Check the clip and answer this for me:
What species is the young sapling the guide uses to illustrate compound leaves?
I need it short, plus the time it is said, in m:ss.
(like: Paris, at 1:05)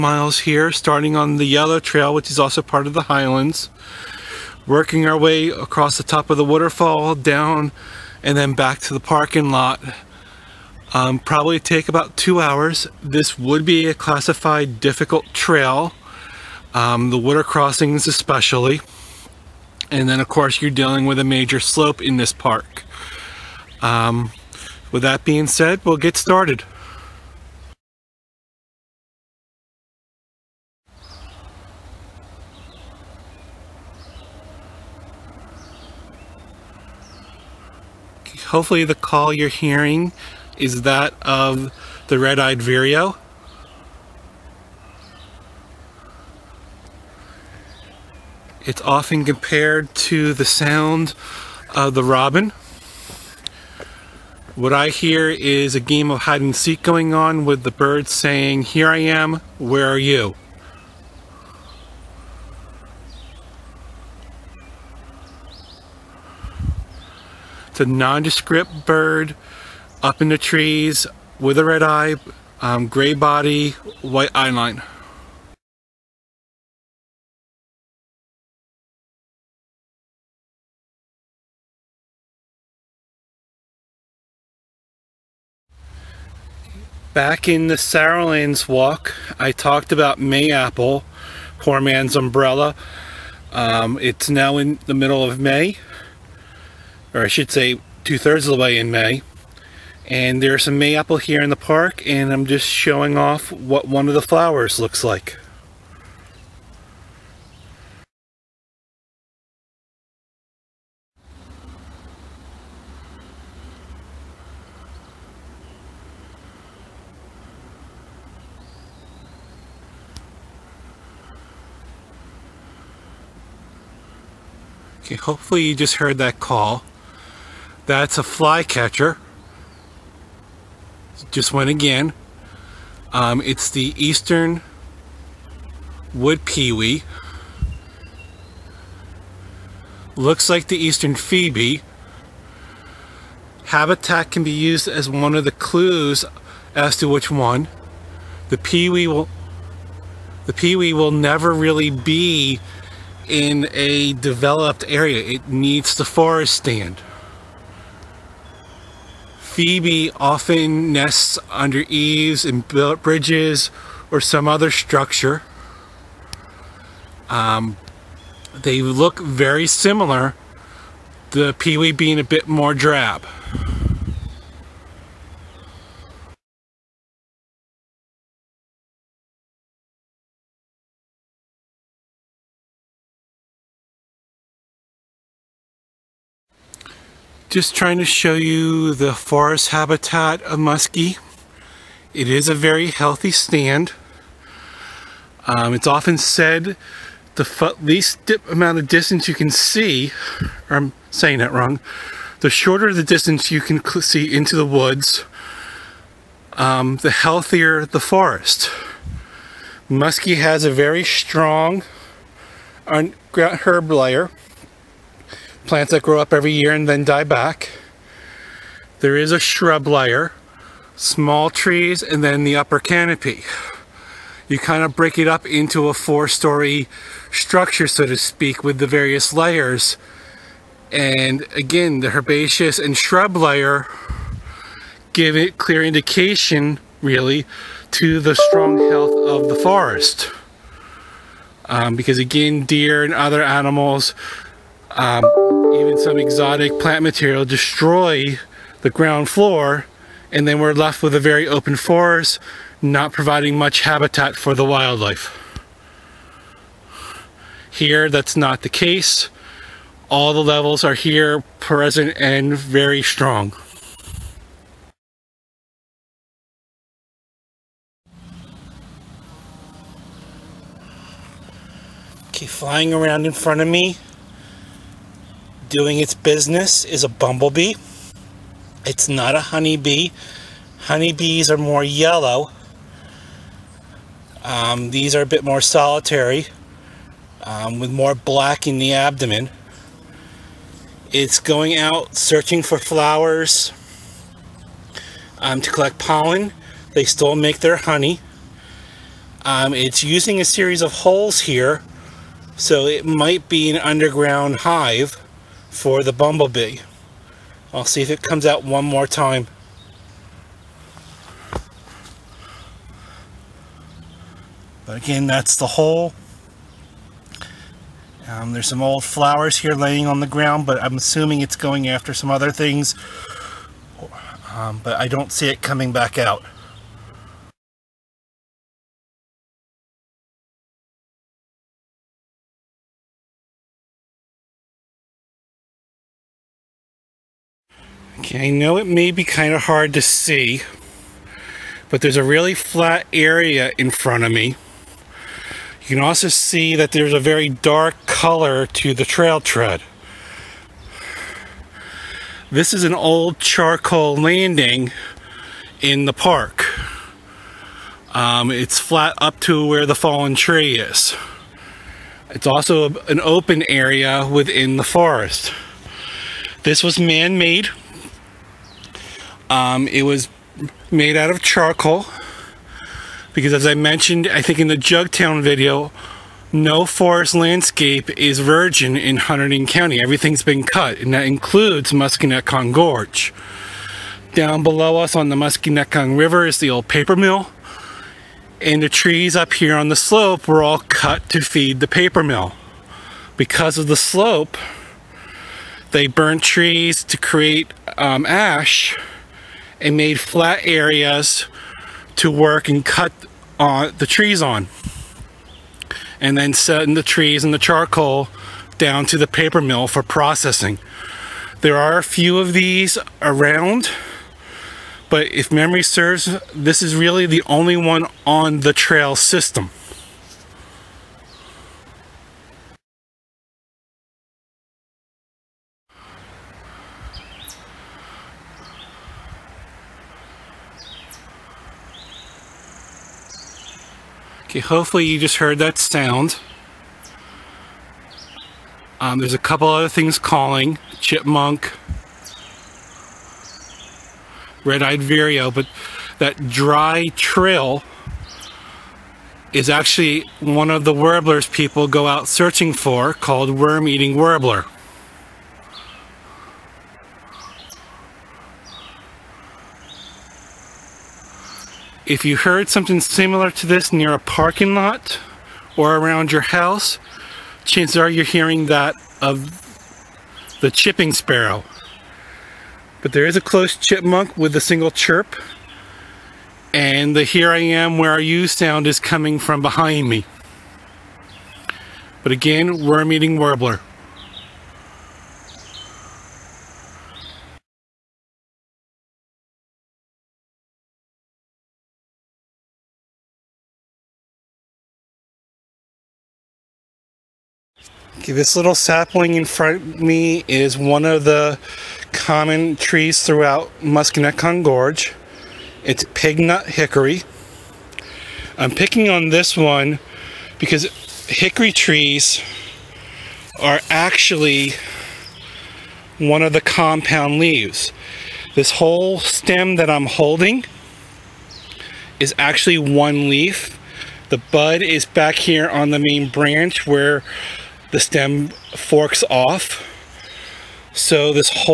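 Pignut hickory, at 8:26.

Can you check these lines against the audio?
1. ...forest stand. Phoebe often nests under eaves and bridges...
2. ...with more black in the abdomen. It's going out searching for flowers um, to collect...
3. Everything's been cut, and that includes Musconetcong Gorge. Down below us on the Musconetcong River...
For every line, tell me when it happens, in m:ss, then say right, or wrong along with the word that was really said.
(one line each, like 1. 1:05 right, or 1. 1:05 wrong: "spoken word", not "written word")
1. 2:36 right
2. 4:47 right
3. 6:20 right.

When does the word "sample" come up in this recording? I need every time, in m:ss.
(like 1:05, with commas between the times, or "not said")
not said.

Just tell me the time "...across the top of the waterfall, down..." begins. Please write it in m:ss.
0:05.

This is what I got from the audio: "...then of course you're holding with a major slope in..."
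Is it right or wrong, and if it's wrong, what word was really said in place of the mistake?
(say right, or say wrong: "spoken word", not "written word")
wrong: "dealing", not "holding".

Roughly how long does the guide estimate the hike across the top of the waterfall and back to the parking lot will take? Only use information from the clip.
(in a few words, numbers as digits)
2 hours.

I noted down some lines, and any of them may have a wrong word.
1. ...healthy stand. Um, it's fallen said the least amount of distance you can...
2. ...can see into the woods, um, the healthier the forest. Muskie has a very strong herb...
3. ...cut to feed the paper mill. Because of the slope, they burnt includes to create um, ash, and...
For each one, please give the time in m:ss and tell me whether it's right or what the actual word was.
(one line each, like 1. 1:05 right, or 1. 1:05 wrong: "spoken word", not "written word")
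1. 3:12 wrong: "often", not "fallen"
2. 3:23 right
3. 6:30 wrong: "trees", not "includes".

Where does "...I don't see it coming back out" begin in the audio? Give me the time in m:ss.
5:24.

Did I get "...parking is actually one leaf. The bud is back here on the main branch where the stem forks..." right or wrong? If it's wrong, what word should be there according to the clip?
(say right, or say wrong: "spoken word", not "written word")
wrong: "holding", not "parking".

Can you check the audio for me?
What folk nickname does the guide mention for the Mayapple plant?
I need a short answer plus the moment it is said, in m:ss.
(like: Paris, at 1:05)
Poor man's umbrella, at 1:31.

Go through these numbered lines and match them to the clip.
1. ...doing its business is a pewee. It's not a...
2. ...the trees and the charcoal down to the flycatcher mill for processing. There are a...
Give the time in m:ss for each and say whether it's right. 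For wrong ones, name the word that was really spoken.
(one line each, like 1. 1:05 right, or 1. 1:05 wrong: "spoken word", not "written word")
1. 4:35 wrong: "bumblebee", not "pewee"
2. 6:46 wrong: "paper", not "flycatcher".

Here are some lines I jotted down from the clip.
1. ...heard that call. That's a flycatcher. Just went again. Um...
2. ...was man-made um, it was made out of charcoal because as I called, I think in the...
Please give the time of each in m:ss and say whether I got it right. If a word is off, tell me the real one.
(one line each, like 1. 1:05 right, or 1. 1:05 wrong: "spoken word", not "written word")
1. 2:05 right
2. 6:06 wrong: "mentioned", not "called".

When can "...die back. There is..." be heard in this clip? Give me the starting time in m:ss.
3:37.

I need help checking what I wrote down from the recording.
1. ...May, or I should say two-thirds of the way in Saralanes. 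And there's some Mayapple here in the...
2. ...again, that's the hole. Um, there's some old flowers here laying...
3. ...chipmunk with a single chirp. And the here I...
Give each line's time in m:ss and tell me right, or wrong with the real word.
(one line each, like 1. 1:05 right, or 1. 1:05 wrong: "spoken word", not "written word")
1. 1:35 wrong: "May", not "Saralanes"
2. 5:14 right
3. 7:53 right.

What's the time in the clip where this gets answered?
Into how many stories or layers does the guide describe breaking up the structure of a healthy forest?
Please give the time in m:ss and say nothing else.
3:45.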